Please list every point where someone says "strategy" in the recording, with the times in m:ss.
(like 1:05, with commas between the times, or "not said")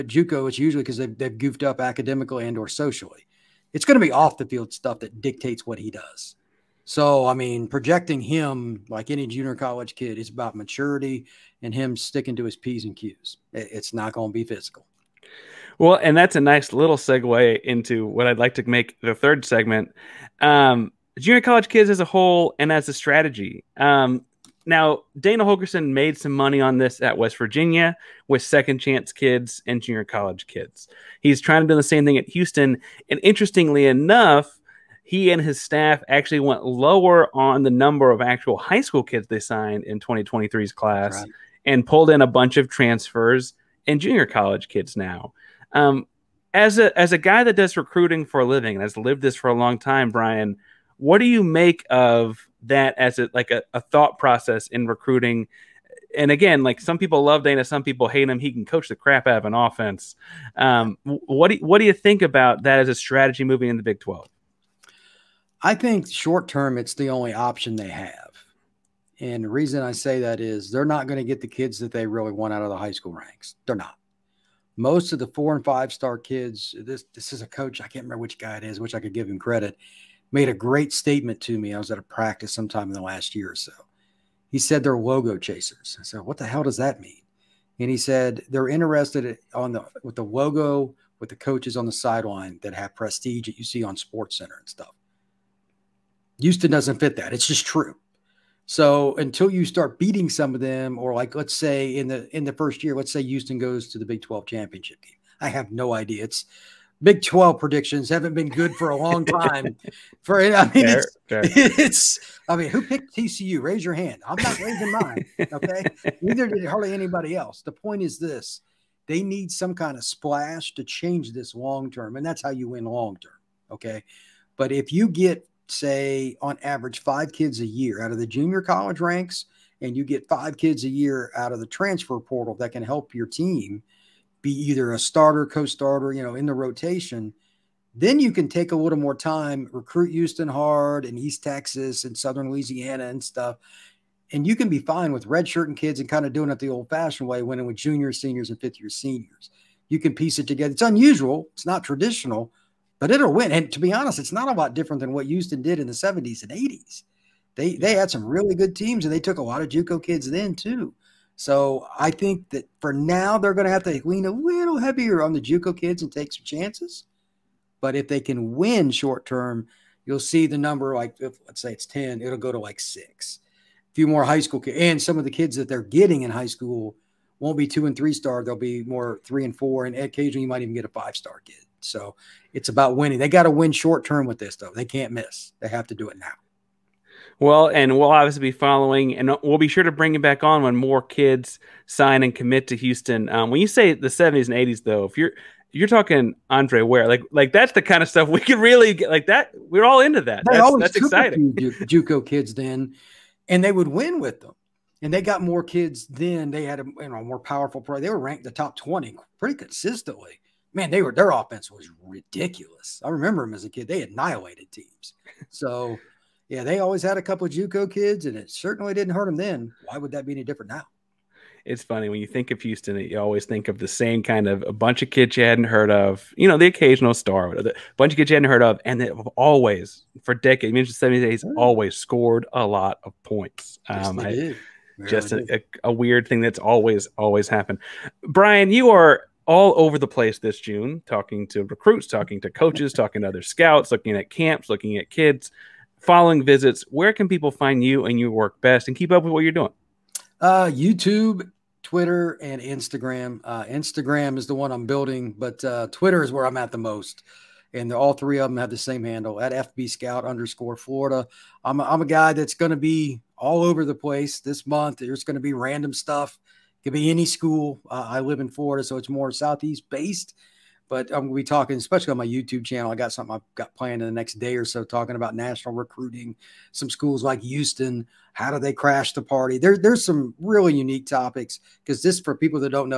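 0:22, 1:02.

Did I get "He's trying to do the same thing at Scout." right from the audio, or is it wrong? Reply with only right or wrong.
wrong.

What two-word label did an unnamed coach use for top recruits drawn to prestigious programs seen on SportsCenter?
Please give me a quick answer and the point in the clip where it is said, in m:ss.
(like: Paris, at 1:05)
logo chasers, at 1:24.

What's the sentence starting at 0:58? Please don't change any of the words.
He can coach the crap out of an offense.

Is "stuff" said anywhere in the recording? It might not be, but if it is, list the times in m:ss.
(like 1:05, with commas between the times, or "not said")
0:04, 1:34, 2:23, 3:18, 4:25.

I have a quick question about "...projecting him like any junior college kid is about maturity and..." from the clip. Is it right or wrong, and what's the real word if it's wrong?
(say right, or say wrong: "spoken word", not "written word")
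right.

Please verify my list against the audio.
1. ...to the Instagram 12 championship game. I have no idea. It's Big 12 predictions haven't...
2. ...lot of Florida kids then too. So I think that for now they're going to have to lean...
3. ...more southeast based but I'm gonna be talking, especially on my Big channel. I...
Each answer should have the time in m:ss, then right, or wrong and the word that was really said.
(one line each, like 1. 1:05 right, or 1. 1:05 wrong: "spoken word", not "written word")
1. 1:43 wrong: "Big", not "Instagram"
2. 2:39 wrong: "JUCO", not "Florida"
3. 4:29 wrong: "YouTube", not "Big".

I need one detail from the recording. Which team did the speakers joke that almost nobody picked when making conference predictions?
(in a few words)
TCU.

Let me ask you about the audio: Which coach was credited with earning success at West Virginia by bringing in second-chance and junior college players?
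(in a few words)
Dana Holgorsen.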